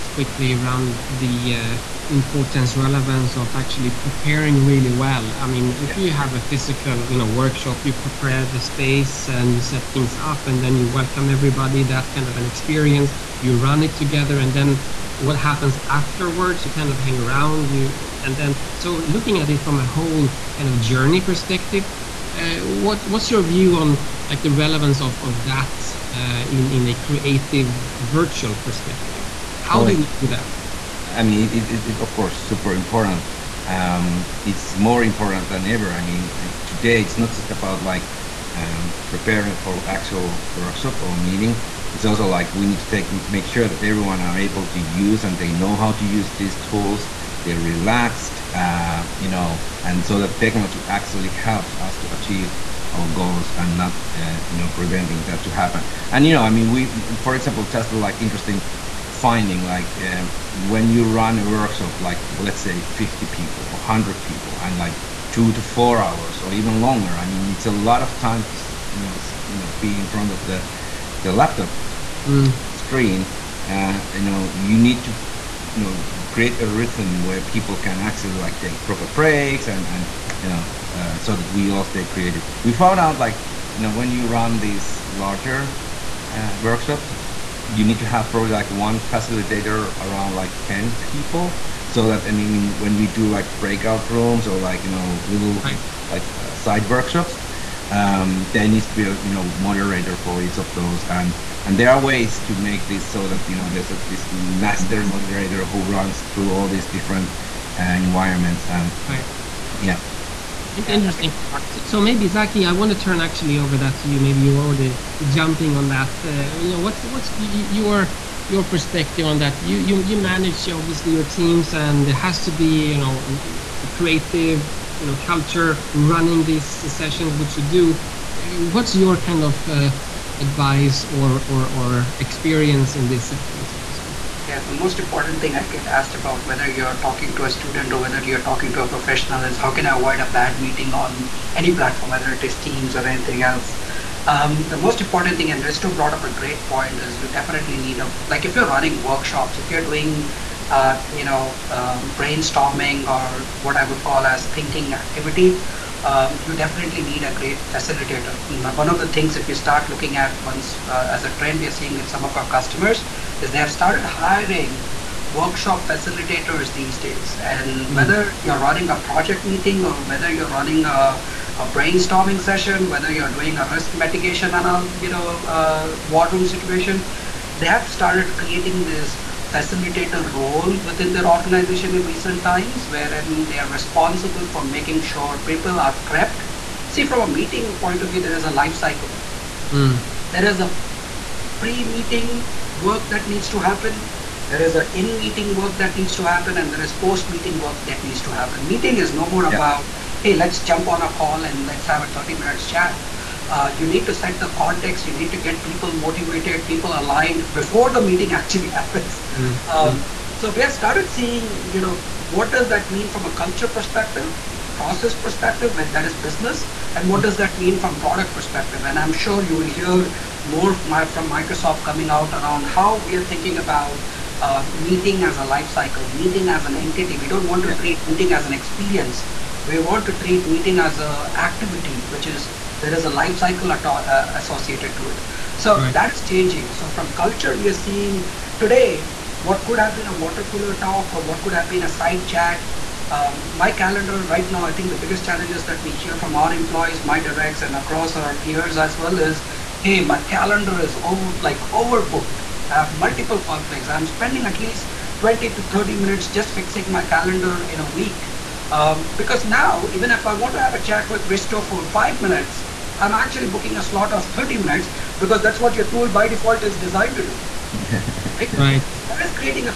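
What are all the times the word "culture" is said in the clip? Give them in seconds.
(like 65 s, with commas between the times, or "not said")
125 s, 213 s, 237 s.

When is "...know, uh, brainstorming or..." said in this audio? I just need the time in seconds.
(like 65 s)
151 s.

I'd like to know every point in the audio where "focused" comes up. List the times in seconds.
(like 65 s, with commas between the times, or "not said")
not said.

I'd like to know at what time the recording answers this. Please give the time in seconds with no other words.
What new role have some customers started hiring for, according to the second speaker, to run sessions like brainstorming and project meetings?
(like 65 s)
165 s.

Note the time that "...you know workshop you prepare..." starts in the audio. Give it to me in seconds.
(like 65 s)
7 s.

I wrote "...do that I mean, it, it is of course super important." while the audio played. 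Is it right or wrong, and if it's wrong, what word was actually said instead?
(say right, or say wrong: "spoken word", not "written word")
right.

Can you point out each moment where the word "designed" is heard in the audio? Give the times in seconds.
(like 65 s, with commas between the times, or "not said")
266 s.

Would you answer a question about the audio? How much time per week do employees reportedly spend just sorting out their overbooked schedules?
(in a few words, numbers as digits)
20 to 30 minutes.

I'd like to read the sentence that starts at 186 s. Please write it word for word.
See, from a meeting point of view, there is a life cycle.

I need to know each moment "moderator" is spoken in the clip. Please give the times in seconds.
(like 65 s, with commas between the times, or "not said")
99 s, 105 s.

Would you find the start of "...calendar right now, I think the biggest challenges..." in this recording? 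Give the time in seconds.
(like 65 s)
243 s.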